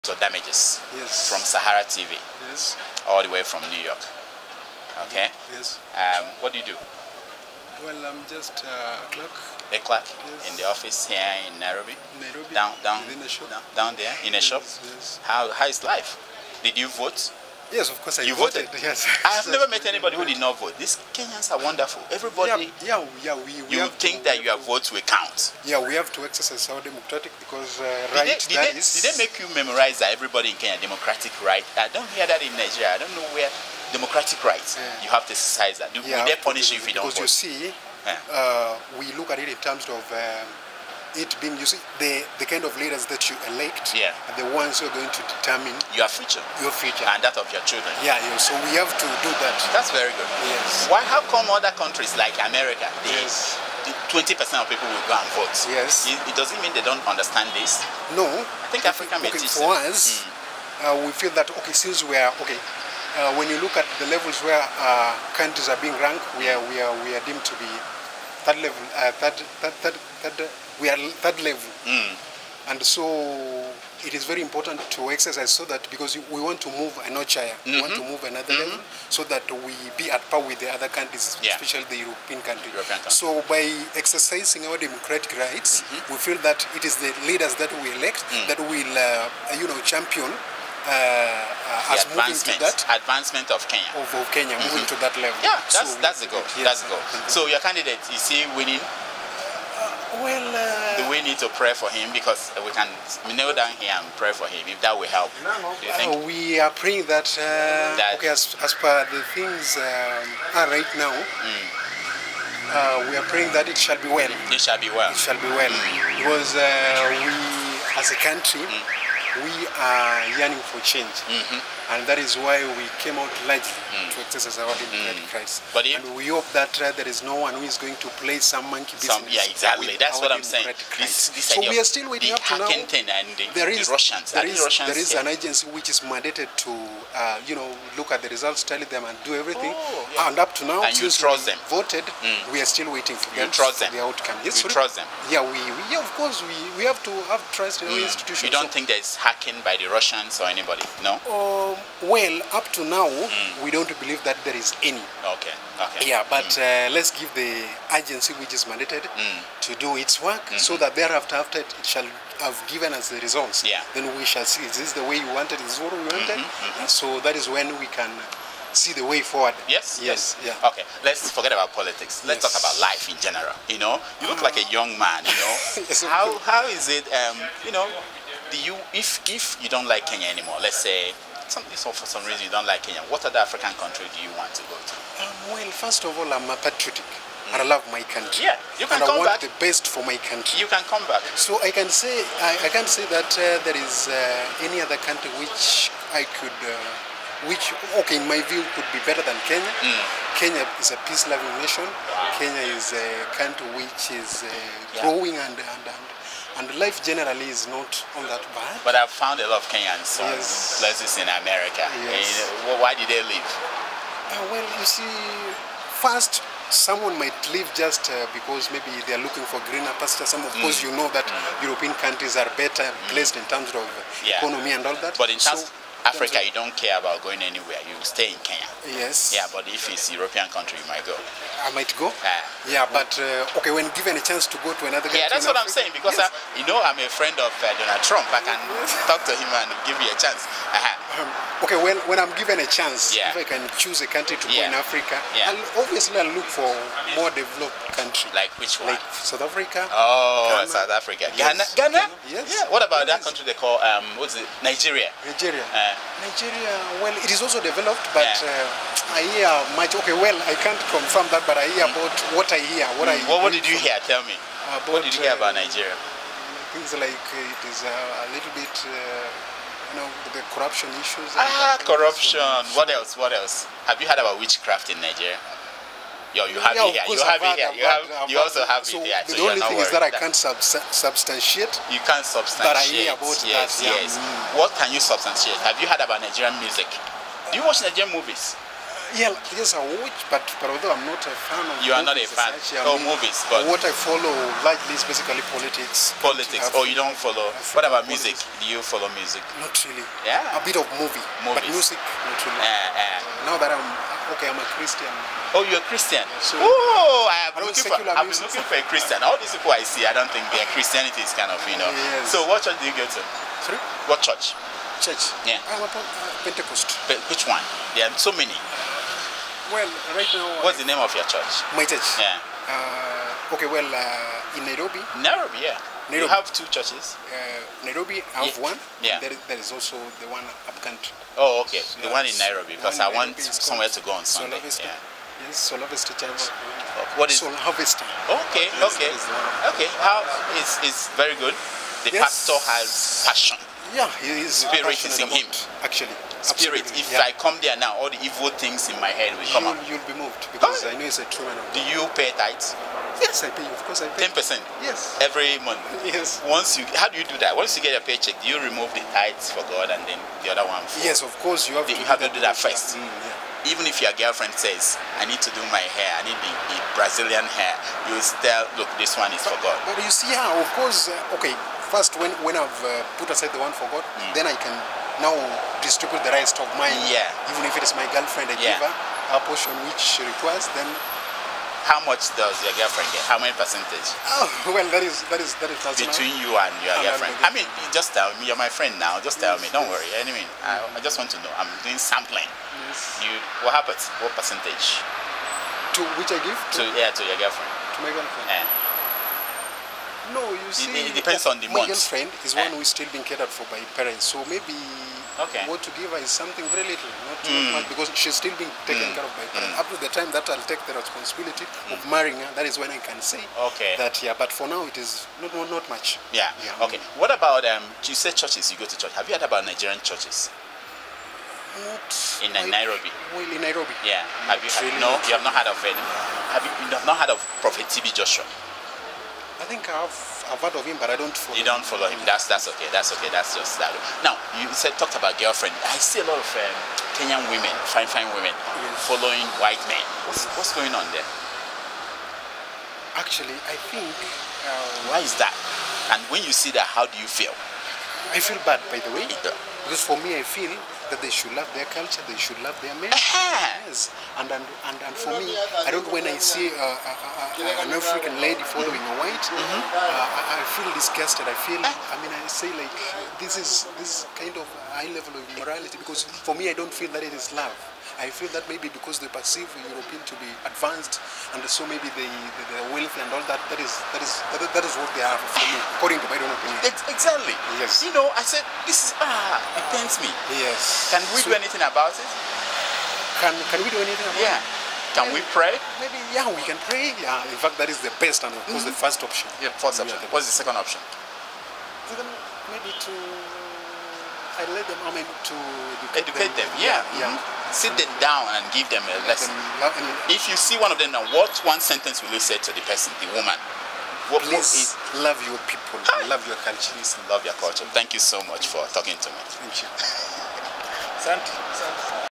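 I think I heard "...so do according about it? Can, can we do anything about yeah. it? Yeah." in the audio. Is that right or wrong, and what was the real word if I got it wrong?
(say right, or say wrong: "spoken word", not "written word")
wrong: "anything", not "according".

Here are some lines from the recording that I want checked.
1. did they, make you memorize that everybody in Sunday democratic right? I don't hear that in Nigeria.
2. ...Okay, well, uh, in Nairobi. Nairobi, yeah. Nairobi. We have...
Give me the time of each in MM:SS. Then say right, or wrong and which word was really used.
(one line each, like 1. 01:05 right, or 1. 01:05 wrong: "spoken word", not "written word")
1. 00:29 wrong: "Kenya", not "Sunday"
2. 05:23 right.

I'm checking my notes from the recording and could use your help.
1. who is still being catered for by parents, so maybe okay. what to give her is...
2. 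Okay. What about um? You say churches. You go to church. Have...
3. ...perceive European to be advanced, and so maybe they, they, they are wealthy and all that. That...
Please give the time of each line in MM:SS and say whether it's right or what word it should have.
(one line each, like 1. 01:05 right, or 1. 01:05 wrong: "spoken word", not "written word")
1. 06:42 right
2. 06:56 right
3. 07:49 right.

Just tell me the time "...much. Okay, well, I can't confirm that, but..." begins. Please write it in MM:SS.
04:19.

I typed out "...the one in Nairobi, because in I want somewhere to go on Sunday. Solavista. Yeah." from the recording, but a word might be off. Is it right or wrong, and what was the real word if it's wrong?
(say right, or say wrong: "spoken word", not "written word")
right.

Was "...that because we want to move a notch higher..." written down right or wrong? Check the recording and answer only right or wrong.
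right.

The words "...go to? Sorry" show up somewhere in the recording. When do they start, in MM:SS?
05:12.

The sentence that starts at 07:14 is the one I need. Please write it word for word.
Now you said talked about girlfriend.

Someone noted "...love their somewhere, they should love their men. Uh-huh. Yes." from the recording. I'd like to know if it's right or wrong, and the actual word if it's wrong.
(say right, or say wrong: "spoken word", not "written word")
wrong: "culture", not "somewhere".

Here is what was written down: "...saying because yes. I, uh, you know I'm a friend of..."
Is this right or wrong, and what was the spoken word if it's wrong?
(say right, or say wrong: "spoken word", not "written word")
right.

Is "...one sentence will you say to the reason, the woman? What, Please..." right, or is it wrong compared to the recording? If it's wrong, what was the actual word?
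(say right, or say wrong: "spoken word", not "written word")
wrong: "person", not "reason".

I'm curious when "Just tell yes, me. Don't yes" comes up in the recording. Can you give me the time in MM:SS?
06:29.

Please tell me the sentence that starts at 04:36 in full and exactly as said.
Yo, you have yeah, it here.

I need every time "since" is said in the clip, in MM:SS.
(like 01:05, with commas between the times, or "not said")
01:01, 02:20.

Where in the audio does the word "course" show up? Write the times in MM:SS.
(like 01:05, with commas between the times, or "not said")
00:18, 02:26, 03:40, 05:53, 06:01, 06:10, 08:08.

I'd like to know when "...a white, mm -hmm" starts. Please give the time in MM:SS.
07:39.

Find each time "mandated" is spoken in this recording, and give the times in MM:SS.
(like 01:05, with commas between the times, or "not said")
02:15, 02:38.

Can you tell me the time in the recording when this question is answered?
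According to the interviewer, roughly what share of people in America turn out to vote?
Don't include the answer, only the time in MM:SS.
00:54.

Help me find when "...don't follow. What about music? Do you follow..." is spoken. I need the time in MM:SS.
04:56.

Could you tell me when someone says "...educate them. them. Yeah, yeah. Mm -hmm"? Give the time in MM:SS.
08:16.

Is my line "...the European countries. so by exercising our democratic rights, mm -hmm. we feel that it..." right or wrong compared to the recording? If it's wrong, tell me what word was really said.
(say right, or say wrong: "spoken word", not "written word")
right.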